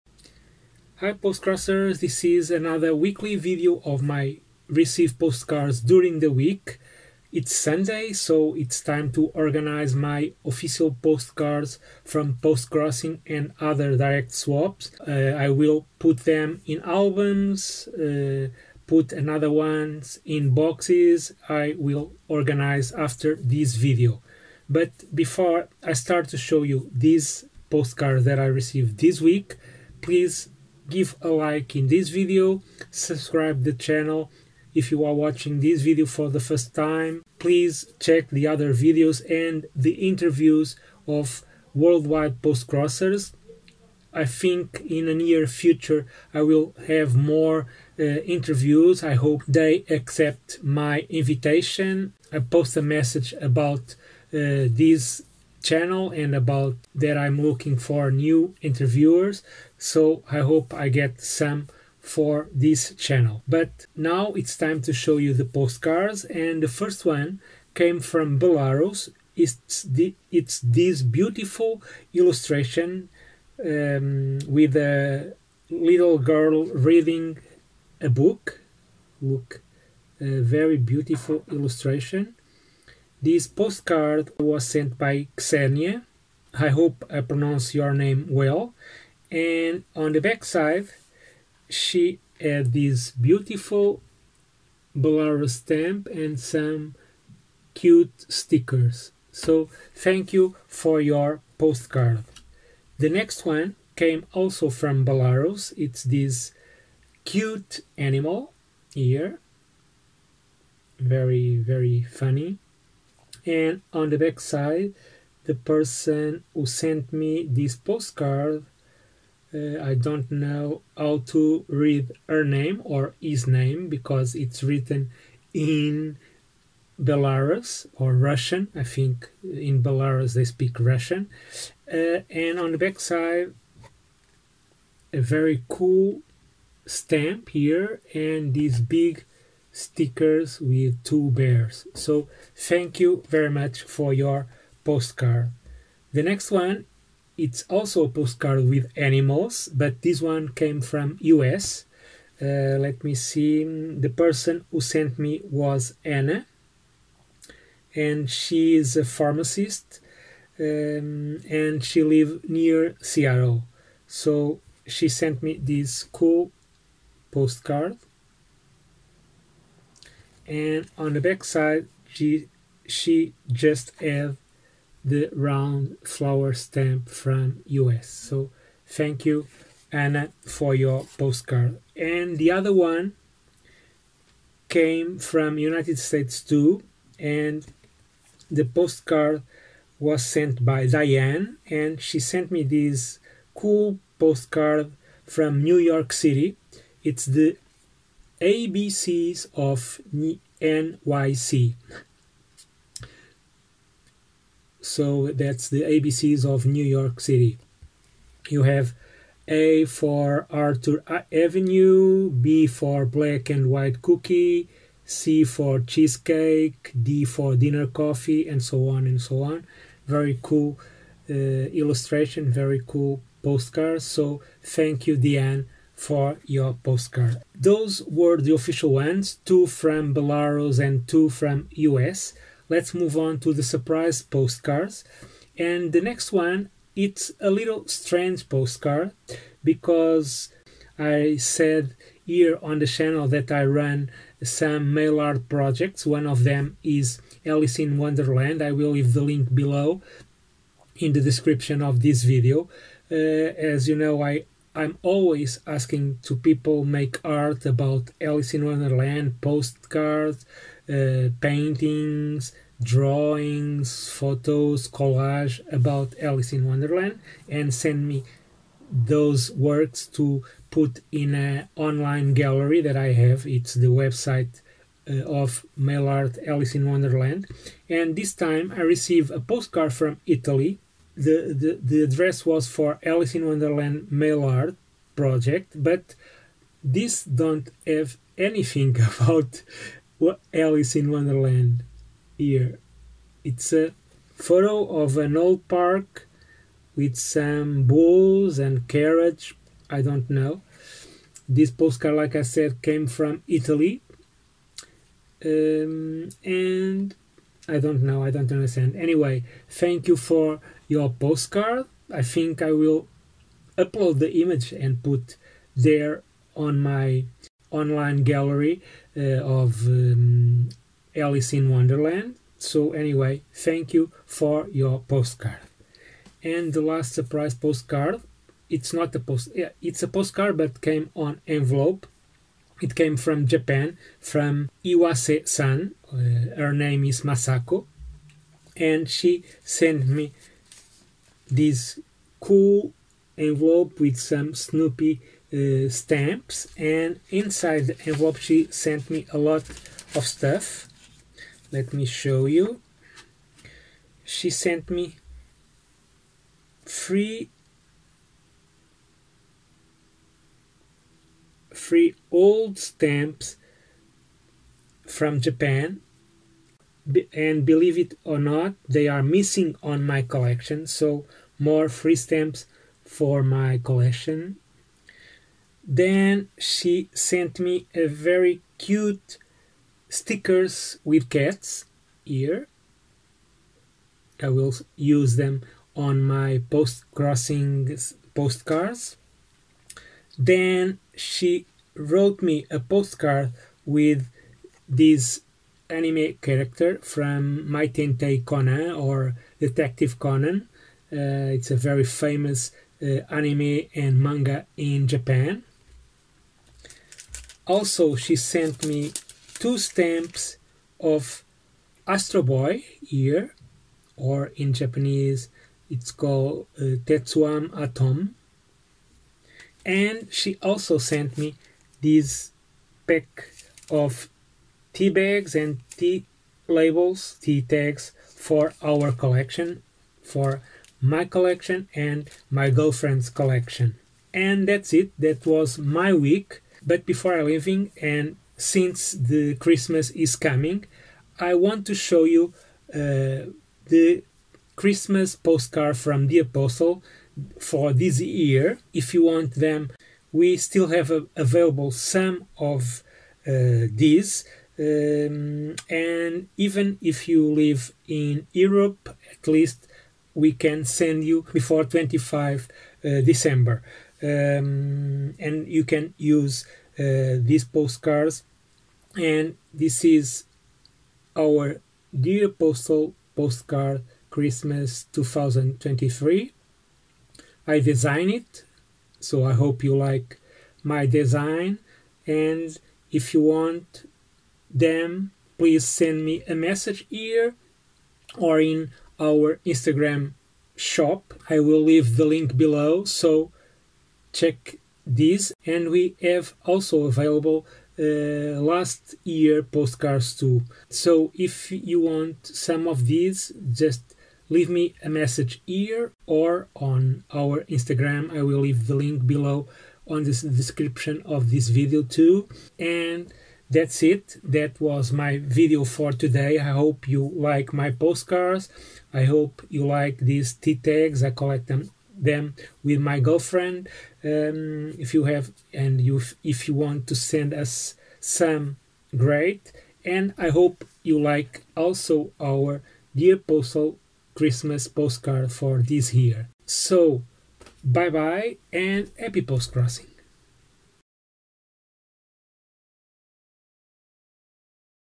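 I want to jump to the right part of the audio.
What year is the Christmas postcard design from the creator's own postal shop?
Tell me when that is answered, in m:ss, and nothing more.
7:55.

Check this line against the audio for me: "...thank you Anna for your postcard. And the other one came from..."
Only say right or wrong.
right.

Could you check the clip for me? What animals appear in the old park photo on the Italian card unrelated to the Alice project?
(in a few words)
bulls.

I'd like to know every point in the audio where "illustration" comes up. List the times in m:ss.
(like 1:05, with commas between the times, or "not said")
1:12, 1:21, 3:41.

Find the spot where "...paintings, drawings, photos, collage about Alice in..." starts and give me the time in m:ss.
4:21.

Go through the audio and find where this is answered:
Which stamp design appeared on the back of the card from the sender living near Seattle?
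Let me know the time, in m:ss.
2:55.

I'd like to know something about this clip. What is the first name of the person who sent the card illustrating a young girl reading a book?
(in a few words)
Xenia.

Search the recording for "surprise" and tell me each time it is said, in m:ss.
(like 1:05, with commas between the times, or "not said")
3:53, 5:27.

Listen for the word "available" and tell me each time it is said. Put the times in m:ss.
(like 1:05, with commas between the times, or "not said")
7:31, 8:17.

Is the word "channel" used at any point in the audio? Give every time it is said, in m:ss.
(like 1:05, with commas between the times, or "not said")
0:33, 0:55, 1:02, 4:02.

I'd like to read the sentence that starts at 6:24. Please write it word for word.
I will use them on my post crossing postcards.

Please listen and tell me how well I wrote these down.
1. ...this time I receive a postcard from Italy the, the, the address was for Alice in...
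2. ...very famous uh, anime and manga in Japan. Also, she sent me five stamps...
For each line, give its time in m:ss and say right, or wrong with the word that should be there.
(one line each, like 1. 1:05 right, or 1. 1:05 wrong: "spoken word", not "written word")
1. 4:38 right
2. 6:41 wrong: "two", not "five".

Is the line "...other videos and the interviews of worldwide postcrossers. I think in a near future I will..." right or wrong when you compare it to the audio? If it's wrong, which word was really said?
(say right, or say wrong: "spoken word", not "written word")
right.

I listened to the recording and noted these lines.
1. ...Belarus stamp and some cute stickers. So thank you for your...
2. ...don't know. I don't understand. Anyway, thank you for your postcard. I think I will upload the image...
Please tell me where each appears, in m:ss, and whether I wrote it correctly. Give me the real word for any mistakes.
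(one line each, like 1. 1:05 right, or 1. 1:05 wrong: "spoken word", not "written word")
1. 1:34 right
2. 5:07 right.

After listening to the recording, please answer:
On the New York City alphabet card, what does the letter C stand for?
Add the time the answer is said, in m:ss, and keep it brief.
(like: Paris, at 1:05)
Cheesecake, at 3:35.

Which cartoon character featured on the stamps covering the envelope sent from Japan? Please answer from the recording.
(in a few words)
Snoopy.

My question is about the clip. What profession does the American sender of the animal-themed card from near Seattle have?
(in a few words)
pharmacist.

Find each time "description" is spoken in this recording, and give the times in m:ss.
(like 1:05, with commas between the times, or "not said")
4:11, 8:30.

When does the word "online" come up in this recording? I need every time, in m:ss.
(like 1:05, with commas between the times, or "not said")
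4:31, 5:17.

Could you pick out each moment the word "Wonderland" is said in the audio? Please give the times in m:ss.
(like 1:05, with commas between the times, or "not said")
4:07, 4:18, 4:26, 4:36, 4:43, 4:51, 5:21.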